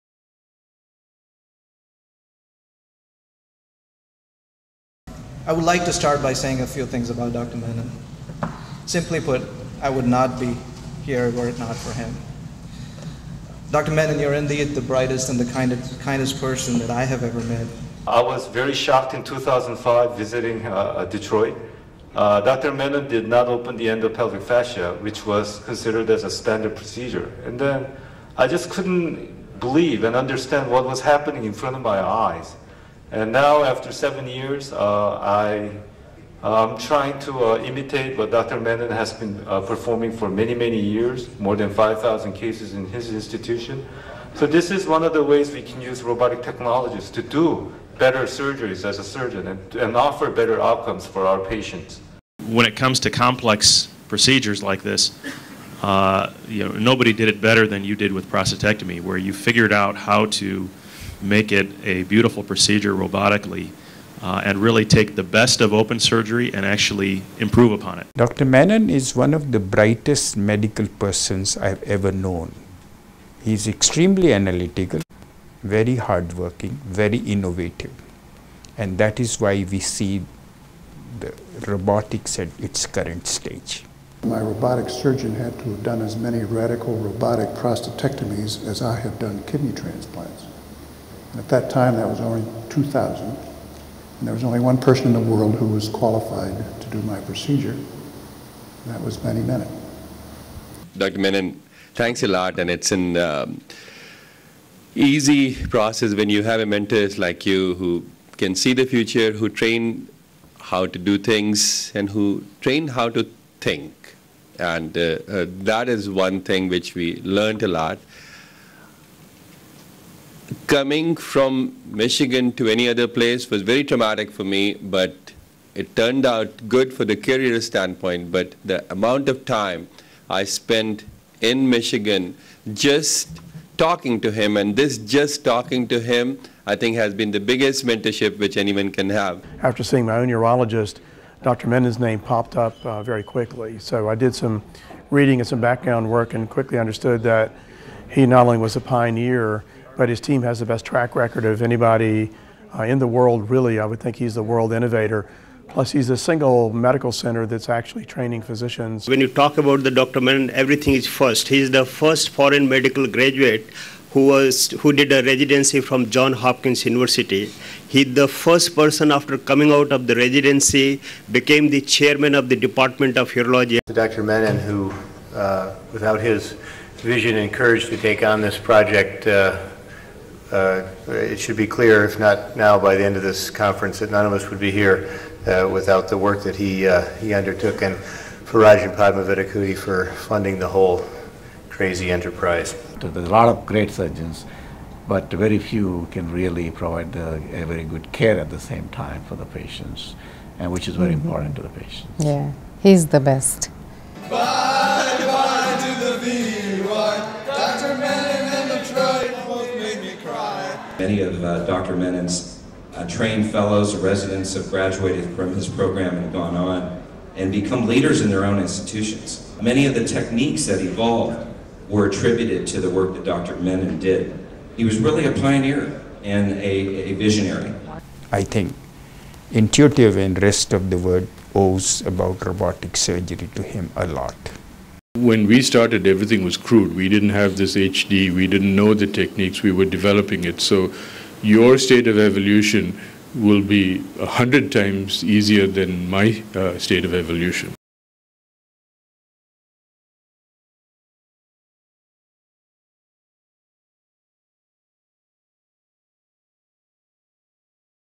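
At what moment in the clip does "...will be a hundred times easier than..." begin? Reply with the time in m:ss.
4:03.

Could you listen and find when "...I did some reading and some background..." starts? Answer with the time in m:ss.
2:24.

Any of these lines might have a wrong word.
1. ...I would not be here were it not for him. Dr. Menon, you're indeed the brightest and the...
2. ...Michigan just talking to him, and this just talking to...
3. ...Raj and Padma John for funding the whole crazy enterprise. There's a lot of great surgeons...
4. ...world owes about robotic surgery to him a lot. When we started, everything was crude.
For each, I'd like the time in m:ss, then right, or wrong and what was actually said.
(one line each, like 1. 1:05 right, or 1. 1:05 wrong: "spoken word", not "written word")
1. 0:09 right
2. 2:11 right
3. 3:08 wrong: "Vattikuti", not "John"
4. 3:50 right.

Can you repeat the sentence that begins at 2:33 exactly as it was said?
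I would think he's the world innovator.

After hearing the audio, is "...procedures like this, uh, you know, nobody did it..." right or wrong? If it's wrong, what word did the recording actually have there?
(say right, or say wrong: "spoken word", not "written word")
right.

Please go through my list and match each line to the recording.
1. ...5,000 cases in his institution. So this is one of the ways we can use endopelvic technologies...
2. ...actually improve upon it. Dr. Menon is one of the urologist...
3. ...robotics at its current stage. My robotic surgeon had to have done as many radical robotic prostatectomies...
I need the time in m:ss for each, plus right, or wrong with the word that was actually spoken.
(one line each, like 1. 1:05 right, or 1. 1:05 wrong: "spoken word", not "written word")
1. 0:41 wrong: "robotic", not "endopelvic"
2. 1:06 wrong: "brightest", not "urologist"
3. 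1:21 right.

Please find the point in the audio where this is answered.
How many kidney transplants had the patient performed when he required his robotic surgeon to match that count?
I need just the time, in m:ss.
1:32.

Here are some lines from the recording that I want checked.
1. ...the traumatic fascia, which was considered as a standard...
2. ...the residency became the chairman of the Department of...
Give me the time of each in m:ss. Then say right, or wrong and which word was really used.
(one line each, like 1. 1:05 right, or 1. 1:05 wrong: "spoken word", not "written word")
1. 0:23 wrong: "endopelvic", not "traumatic"
2. 2:50 right.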